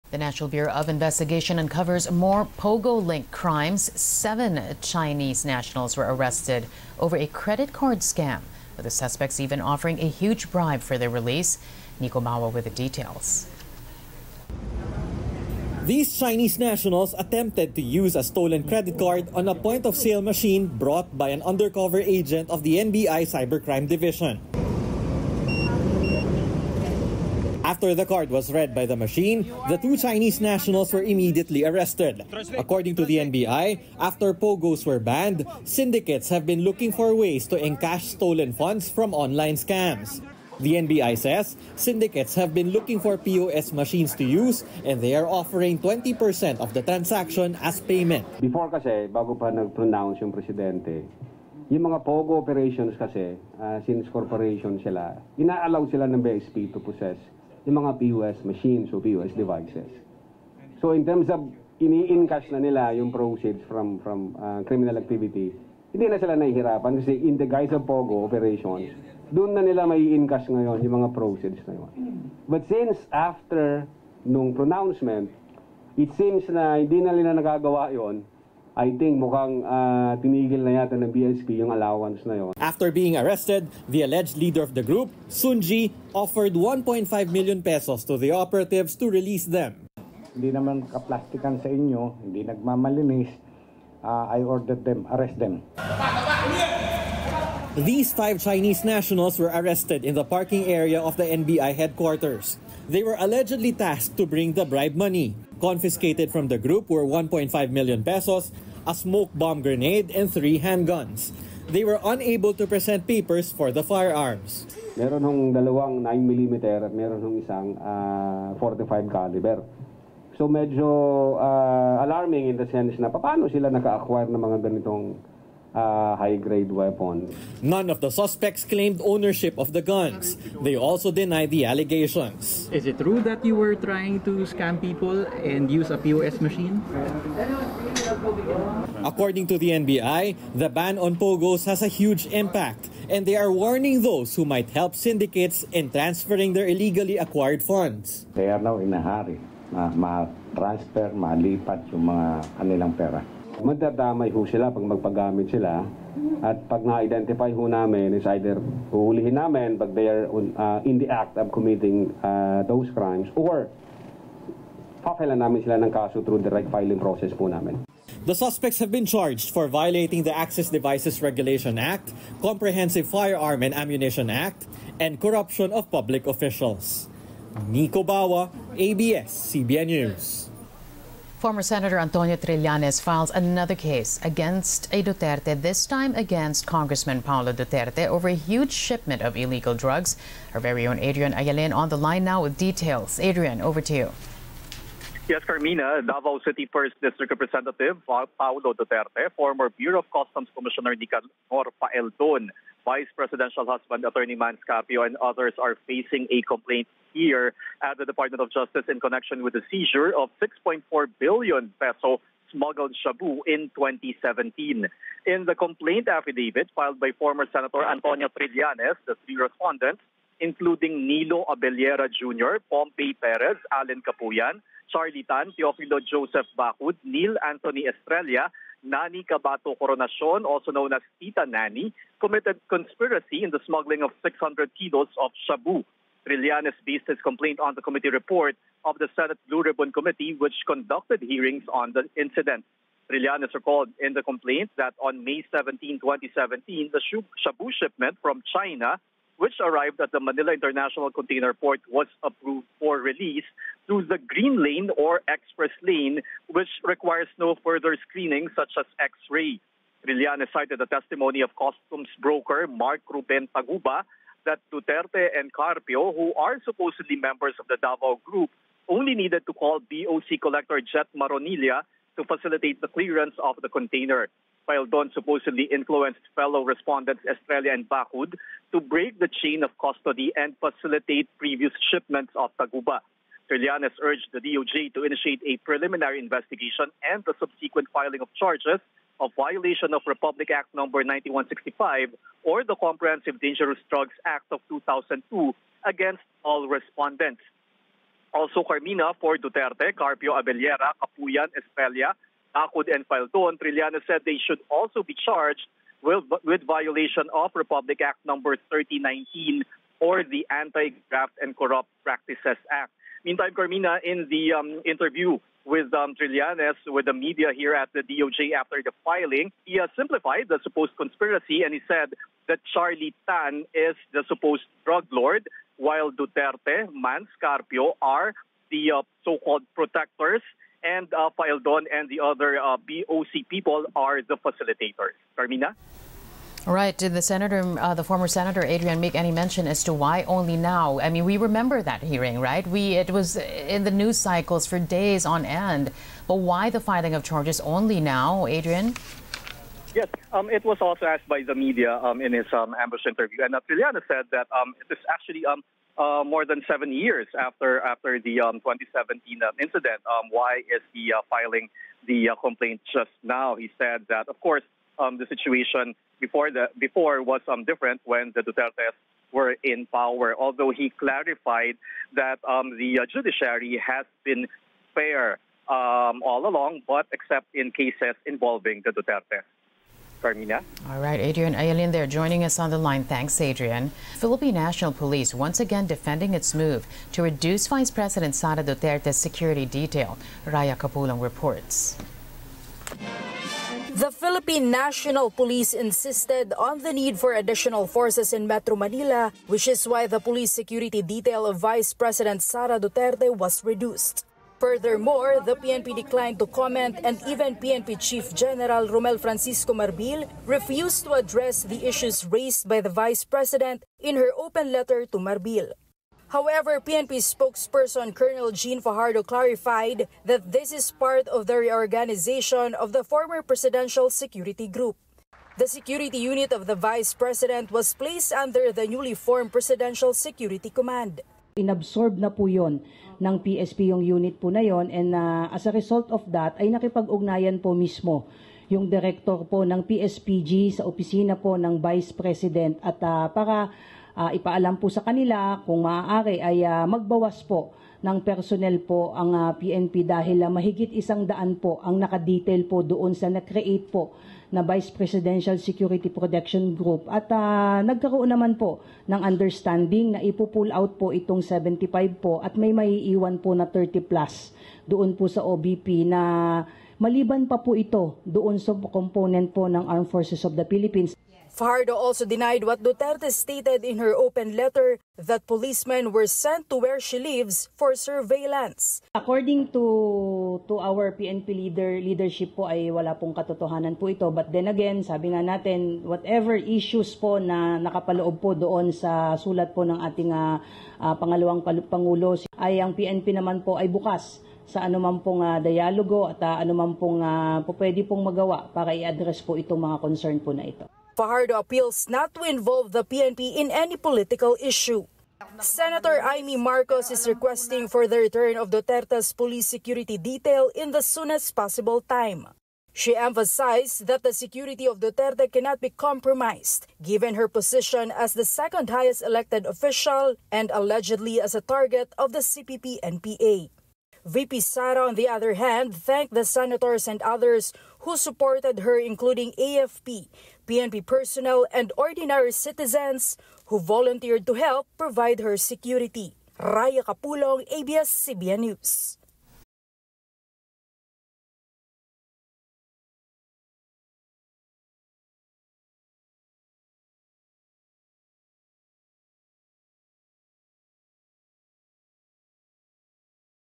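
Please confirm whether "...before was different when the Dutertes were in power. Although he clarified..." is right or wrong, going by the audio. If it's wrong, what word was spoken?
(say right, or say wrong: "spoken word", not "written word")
right.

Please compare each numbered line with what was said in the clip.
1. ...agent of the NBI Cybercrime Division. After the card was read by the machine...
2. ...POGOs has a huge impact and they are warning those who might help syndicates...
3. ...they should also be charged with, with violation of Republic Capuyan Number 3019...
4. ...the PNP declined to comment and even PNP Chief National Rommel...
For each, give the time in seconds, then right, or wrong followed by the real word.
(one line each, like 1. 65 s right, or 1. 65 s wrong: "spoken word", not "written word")
1. 22 s right
2. 141 s right
3. 304 s wrong: "Act", not "Capuyan"
4. 405 s wrong: "General", not "National".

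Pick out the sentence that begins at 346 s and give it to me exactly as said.
But why the filing of charges only now, Adrian?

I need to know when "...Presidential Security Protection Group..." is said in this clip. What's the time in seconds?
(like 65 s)
454 s.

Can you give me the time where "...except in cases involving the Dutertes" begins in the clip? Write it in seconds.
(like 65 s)
377 s.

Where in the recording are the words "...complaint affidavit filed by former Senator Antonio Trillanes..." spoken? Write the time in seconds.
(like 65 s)
215 s.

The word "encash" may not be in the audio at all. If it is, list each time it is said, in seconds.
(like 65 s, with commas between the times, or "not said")
37 s, 61 s, 70 s.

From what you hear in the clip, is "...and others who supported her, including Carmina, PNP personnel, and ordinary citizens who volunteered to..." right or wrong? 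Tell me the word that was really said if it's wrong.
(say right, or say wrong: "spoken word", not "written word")
wrong: "AFP", not "Carmina".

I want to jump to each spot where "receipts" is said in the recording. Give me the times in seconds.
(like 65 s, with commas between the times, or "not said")
not said.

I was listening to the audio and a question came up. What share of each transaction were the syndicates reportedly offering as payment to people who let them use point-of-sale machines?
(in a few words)
20%.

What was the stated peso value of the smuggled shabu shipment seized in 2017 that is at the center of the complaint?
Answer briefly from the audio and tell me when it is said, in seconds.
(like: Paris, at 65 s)
6.4 billion pesos, at 210 s.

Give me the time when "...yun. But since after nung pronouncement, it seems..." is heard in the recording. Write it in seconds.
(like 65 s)
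71 s.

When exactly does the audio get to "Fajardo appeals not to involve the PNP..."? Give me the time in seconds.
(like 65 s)
501 s.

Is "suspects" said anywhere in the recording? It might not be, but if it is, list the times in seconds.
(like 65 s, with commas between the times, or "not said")
8 s, 128 s, 168 s.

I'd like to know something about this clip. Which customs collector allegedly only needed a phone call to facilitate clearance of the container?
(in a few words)
Jet Maronilla.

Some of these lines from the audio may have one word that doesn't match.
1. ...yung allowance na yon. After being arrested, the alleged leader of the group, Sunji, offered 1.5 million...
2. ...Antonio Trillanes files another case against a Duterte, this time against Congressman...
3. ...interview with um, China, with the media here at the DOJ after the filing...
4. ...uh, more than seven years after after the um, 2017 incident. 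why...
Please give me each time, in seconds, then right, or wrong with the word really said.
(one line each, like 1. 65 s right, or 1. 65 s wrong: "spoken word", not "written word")
1. 81 s right
2. 181 s right
3. 314 s wrong: "Trillanes", not "China"
4. 355 s right.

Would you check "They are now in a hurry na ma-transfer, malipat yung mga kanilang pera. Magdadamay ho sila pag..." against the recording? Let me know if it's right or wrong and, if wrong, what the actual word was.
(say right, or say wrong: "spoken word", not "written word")
right.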